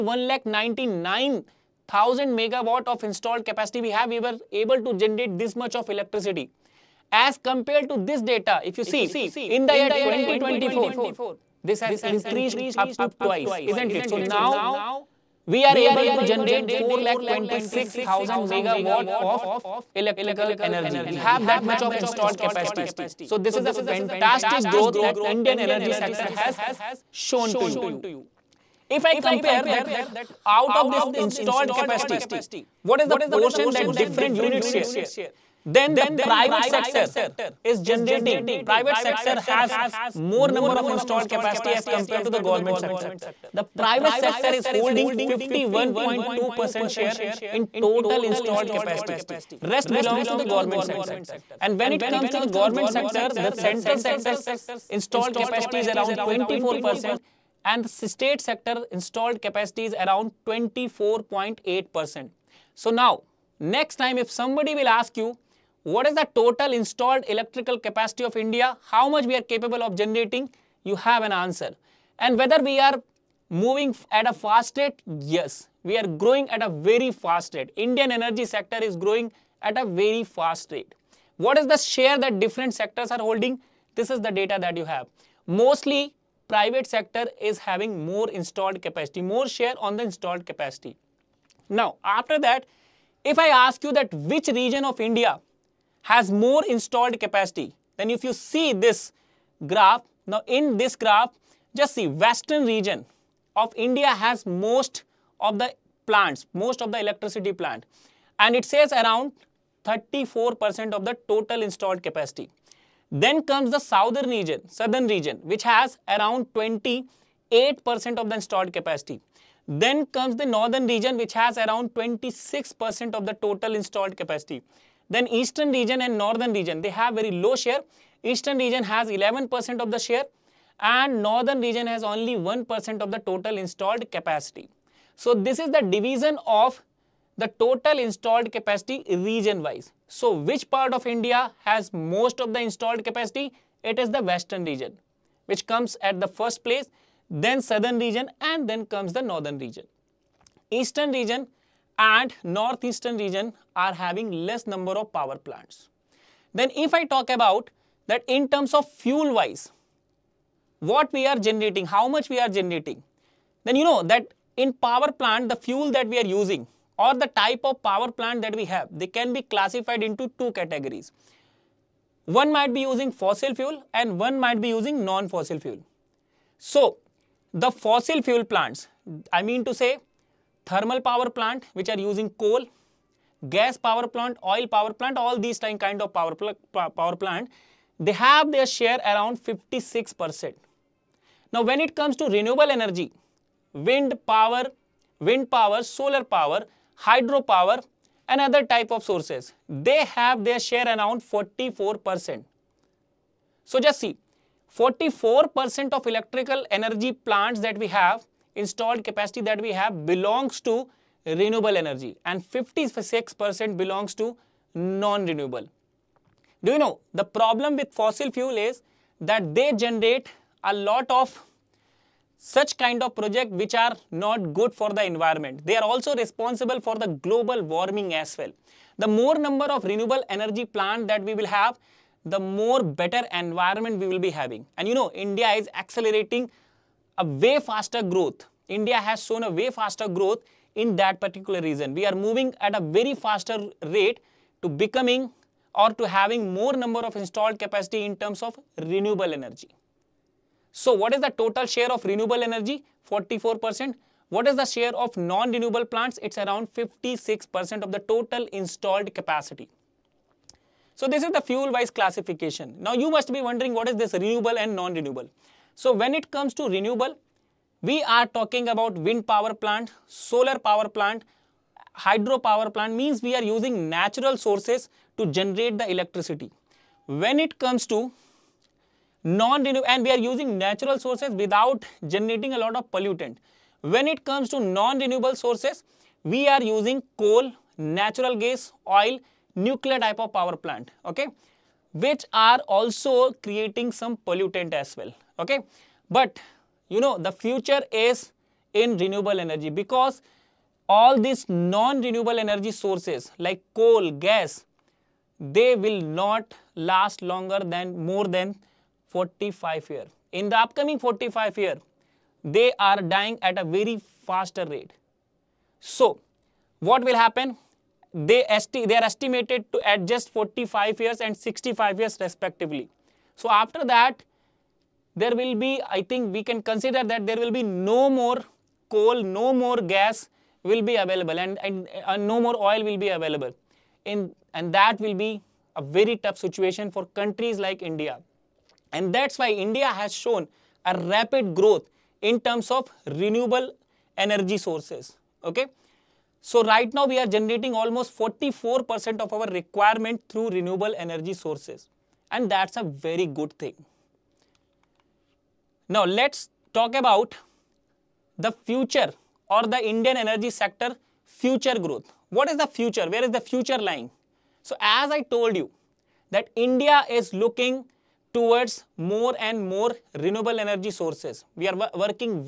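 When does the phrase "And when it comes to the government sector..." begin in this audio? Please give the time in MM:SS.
00:51.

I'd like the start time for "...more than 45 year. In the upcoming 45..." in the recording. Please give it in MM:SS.
05:08.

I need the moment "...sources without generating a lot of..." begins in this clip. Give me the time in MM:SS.
04:40.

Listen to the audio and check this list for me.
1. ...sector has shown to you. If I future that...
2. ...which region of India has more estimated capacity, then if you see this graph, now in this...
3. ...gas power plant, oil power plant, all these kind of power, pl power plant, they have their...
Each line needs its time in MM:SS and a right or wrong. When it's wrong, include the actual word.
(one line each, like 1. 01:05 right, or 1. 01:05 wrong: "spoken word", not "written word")
1. 00:25 wrong: "compare", not "future"
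2. 01:34 wrong: "installed", not "estimated"
3. 03:03 right.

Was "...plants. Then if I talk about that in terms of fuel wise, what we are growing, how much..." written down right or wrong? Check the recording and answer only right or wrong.
wrong.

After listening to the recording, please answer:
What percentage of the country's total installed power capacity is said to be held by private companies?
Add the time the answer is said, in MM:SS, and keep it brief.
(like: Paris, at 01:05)
51.2%, at 00:45.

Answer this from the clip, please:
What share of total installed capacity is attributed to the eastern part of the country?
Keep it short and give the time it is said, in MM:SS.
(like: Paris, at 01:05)
11%, at 02:09.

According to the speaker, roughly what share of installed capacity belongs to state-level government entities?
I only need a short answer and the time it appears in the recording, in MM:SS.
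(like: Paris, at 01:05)
24.8%, at 01:00.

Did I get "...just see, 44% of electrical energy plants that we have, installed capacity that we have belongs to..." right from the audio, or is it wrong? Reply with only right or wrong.
right.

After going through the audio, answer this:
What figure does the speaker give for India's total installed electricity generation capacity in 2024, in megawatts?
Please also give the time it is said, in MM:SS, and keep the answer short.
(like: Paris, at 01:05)
426,000 megawatts, at 00:16.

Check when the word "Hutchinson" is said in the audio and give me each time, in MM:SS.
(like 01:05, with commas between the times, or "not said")
not said.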